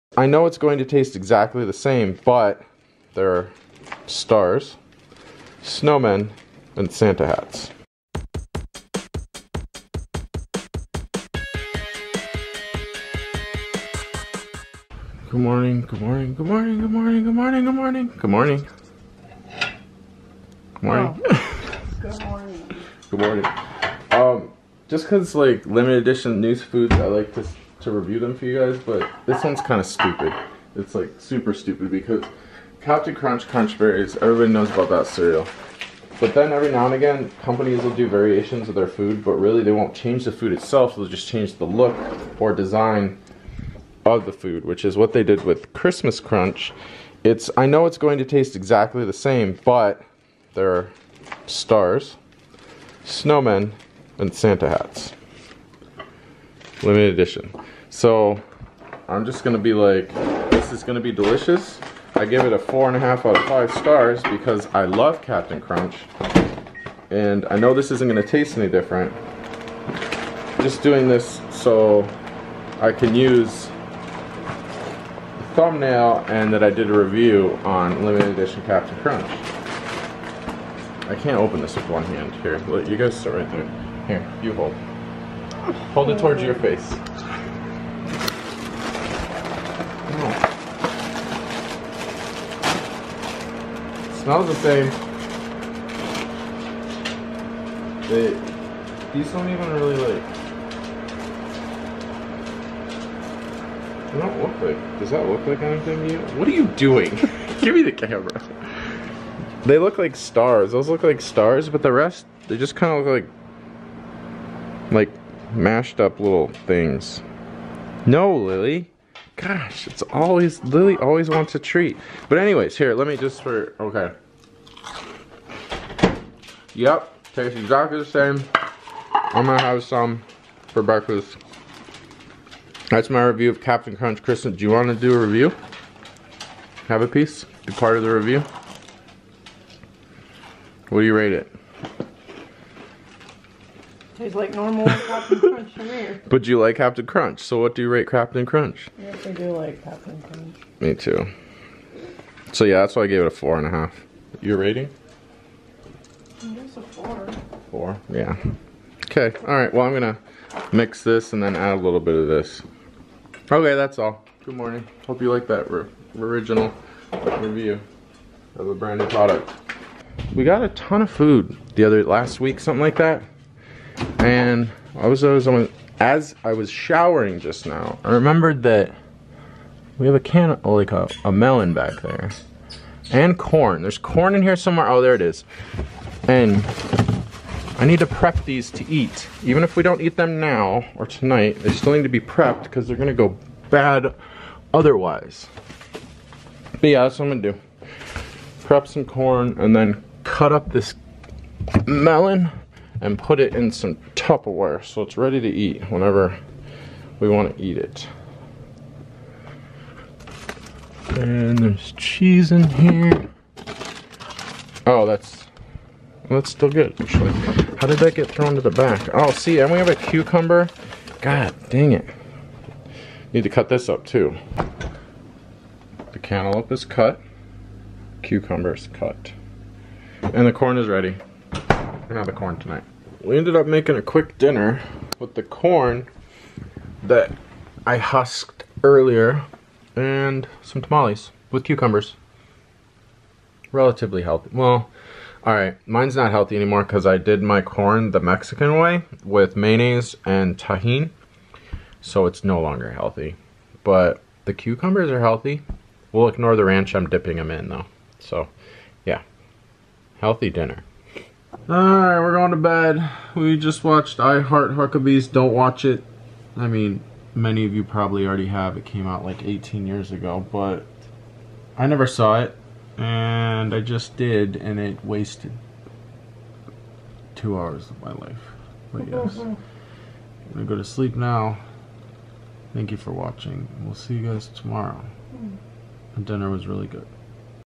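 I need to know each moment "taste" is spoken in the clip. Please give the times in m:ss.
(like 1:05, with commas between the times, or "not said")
0:00, 0:48, 1:08, 2:07, 2:24.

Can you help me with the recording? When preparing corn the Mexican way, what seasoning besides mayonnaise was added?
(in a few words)
Tajín.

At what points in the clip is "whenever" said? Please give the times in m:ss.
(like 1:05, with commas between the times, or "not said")
3:25.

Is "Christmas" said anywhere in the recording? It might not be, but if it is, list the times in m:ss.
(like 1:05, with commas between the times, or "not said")
0:45, 2:14.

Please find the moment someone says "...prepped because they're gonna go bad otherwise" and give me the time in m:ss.
3:12.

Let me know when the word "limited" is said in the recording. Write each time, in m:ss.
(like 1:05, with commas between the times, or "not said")
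0:25, 0:56, 1:18.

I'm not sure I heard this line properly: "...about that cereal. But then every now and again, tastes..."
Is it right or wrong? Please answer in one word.
wrong.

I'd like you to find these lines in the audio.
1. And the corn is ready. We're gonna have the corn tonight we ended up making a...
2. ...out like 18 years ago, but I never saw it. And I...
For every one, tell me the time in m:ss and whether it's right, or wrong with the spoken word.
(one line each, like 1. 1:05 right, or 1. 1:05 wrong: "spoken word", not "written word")
1. 3:50 right
2. 4:29 right.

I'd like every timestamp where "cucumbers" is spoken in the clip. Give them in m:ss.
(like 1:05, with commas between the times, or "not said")
3:39, 3:48, 4:01, 4:14.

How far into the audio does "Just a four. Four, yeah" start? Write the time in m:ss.
2:36.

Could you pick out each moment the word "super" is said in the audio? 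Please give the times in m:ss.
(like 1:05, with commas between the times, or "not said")
0:31.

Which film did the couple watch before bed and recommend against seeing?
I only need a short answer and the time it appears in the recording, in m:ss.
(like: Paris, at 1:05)
I Heart Huckabees, at 4:24.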